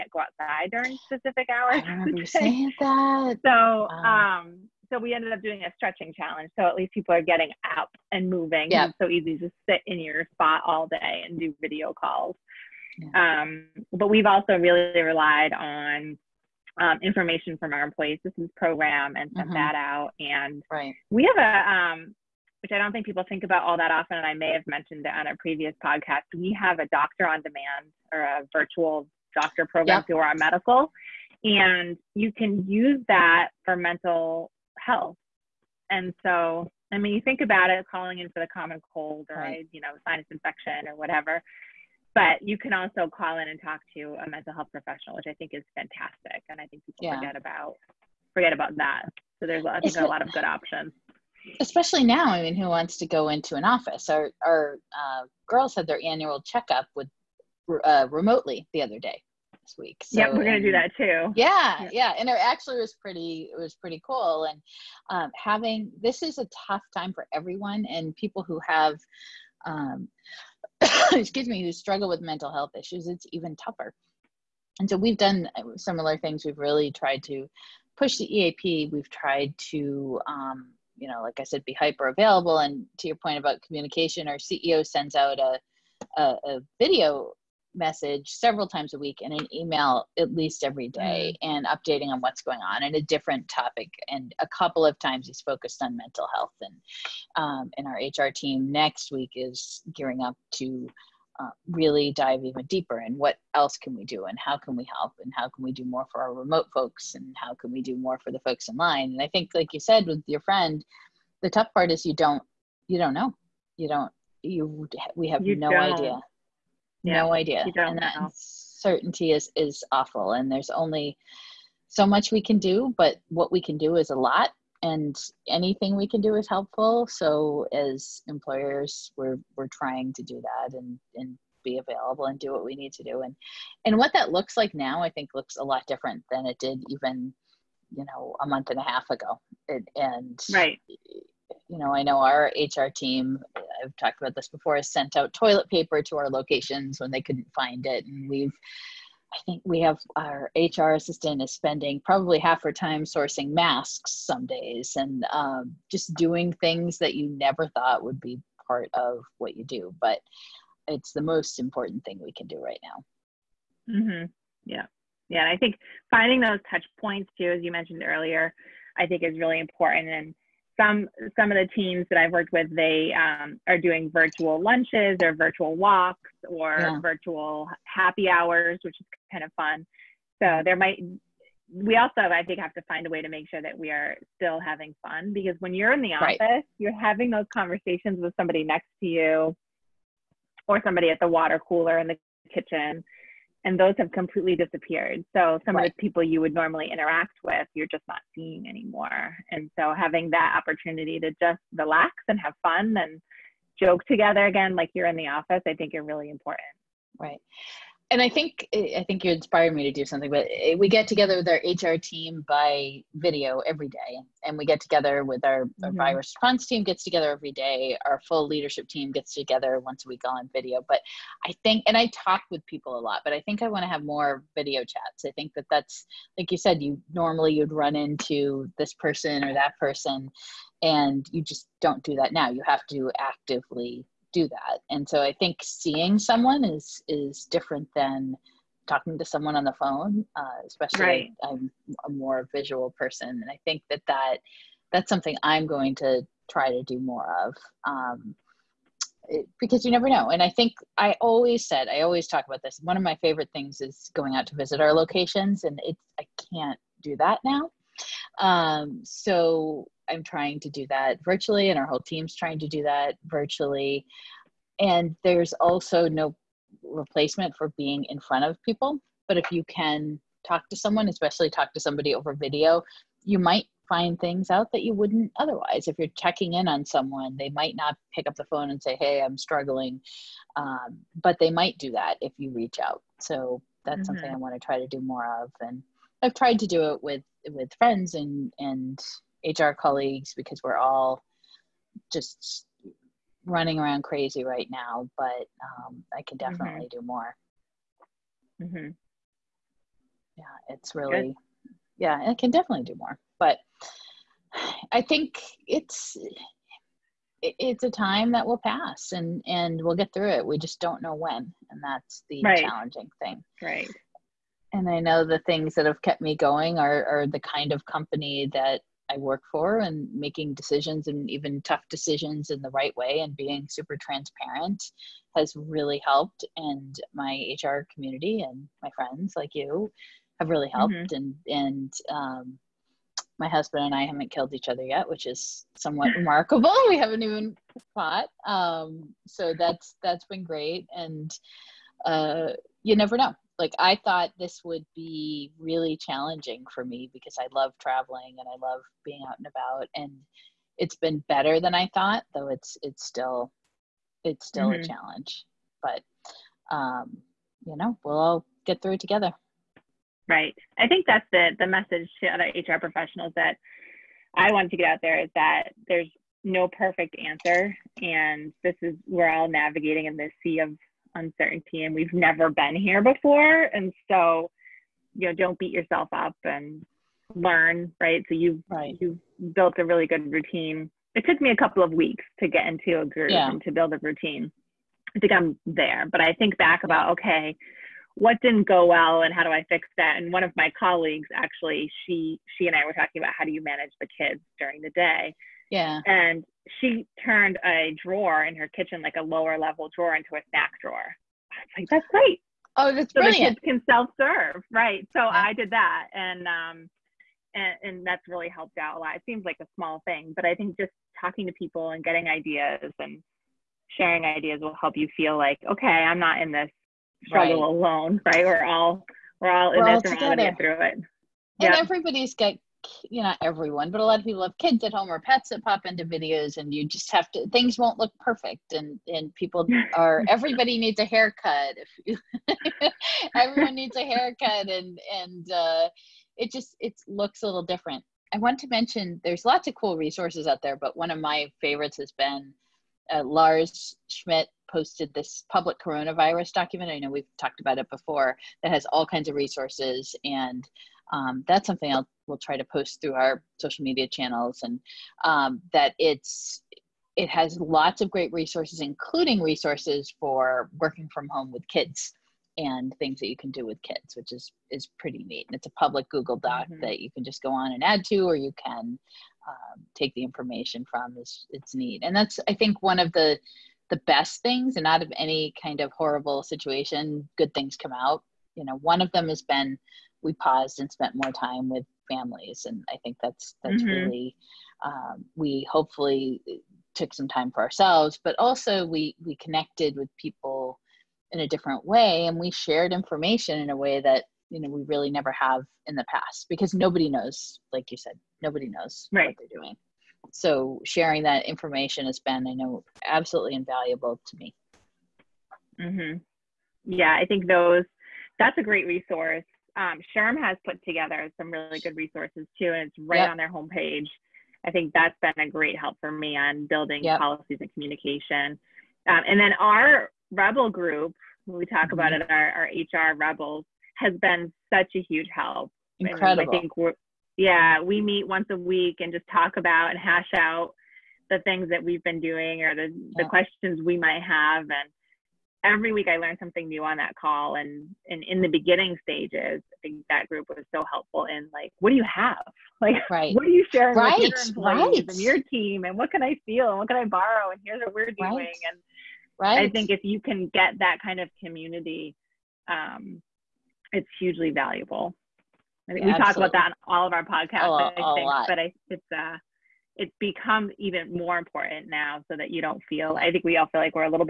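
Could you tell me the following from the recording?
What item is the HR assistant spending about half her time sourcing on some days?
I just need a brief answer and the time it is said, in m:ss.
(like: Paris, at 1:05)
masks, at 2:33.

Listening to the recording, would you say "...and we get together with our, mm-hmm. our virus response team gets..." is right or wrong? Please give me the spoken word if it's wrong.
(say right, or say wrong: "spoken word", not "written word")
right.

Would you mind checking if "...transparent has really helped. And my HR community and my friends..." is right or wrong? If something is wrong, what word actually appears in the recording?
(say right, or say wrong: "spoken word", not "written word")
right.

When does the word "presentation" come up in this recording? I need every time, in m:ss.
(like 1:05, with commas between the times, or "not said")
not said.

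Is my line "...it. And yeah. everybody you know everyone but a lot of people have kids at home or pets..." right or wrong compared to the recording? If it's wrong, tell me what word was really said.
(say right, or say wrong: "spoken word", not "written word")
right.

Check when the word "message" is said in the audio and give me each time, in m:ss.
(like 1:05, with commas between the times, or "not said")
1:27, 6:01.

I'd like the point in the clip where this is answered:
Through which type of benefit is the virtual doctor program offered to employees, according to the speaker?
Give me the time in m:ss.
0:30.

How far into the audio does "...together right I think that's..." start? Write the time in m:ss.
5:58.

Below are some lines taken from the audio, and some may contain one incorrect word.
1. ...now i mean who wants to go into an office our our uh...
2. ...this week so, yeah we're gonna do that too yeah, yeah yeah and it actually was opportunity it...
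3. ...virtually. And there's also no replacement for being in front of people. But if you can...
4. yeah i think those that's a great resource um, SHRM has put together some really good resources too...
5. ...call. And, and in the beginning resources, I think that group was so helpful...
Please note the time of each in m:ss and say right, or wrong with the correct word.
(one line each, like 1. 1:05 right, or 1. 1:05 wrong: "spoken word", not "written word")
1. 0:52 right
2. 0:59 wrong: "pretty", not "opportunity"
3. 4:23 right
4. 8:26 right
5. 8:57 wrong: "stages", not "resources".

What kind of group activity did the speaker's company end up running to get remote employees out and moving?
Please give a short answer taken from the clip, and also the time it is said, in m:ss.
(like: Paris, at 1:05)
stretching challenge, at 0:05.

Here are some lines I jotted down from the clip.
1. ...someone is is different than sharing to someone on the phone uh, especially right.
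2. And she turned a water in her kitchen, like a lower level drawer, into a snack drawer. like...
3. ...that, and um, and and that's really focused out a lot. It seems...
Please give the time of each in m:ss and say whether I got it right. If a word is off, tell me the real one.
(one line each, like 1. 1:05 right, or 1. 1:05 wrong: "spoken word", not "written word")
1. 3:56 wrong: "talking", not "sharing"
2. 6:36 wrong: "drawer", not "water"
3. 6:45 wrong: "helped", not "focused".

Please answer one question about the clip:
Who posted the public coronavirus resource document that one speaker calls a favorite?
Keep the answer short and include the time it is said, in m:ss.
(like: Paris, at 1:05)
Lars Schmidt, at 7:23.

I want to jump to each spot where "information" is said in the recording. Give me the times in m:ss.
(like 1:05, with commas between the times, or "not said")
0:17, 7:50, 8:12, 8:21.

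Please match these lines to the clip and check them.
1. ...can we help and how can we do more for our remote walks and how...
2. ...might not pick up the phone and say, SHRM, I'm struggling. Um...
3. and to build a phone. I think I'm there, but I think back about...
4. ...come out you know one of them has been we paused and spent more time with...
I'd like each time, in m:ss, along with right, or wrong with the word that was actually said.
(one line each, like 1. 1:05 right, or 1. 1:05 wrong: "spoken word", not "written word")
1. 1:44 wrong: "folks", not "walks"
2. 4:37 wrong: "Hey", not "SHRM"
3. 6:23 wrong: "routine", not "phone"
4. 7:57 right.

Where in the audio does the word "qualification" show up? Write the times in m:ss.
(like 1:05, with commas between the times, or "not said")
not said.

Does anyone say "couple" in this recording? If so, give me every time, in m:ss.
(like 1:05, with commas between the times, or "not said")
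1:34, 6:21.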